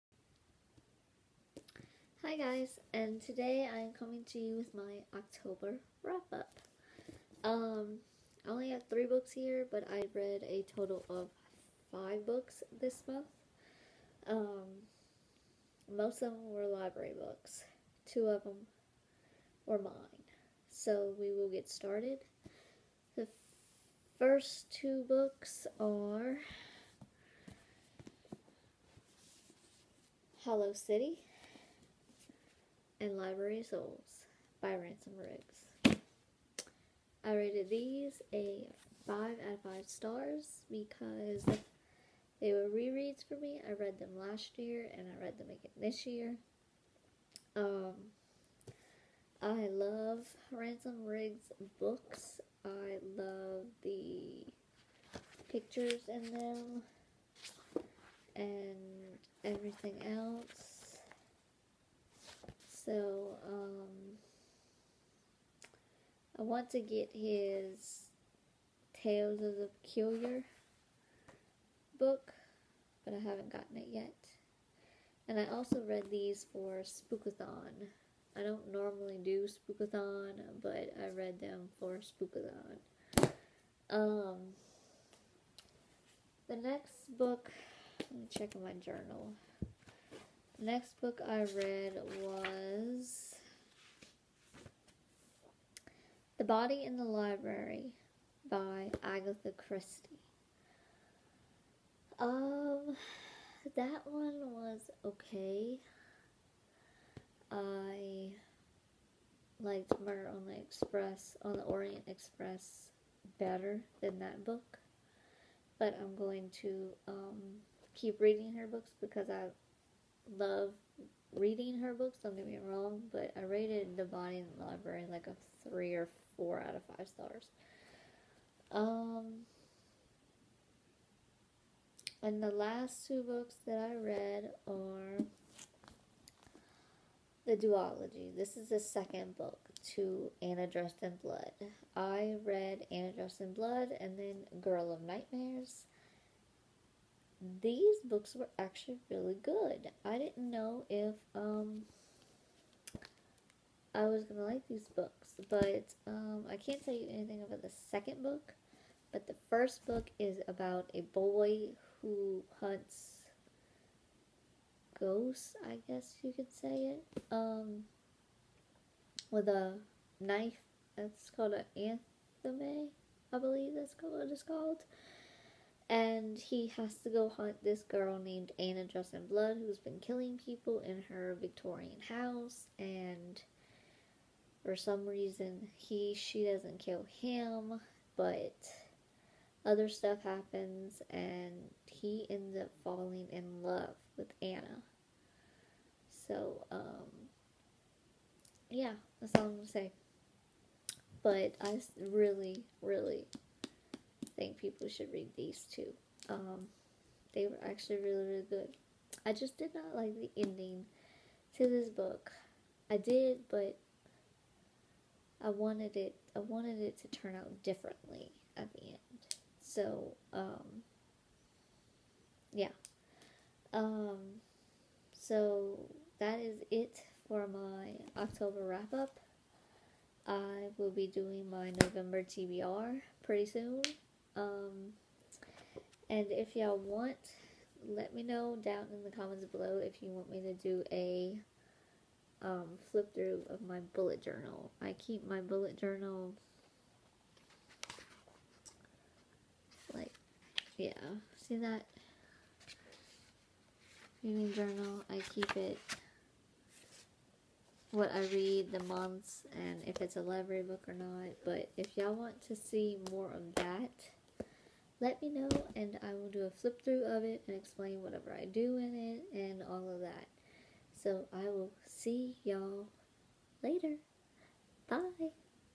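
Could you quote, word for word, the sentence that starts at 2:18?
This is the second book to Anna Dressed in Blood.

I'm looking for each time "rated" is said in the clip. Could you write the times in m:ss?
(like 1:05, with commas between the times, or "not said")
0:37, 2:03.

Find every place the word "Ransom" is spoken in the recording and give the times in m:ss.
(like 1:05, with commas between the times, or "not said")
0:34, 0:50.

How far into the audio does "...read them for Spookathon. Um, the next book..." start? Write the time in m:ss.
1:21.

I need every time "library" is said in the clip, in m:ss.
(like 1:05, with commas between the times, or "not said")
0:16, 0:33, 1:37, 2:04, 4:20.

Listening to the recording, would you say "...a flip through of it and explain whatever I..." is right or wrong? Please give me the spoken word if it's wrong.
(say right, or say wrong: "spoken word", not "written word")
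right.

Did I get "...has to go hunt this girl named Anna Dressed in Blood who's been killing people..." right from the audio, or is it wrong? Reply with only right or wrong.
right.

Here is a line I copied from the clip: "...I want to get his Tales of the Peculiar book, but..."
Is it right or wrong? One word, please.
right.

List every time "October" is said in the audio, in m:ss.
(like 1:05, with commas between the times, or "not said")
0:05, 3:48.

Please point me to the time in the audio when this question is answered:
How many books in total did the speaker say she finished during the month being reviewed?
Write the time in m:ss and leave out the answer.
0:11.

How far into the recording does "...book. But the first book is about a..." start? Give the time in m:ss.
2:38.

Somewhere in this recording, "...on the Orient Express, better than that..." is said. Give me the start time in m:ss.
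1:51.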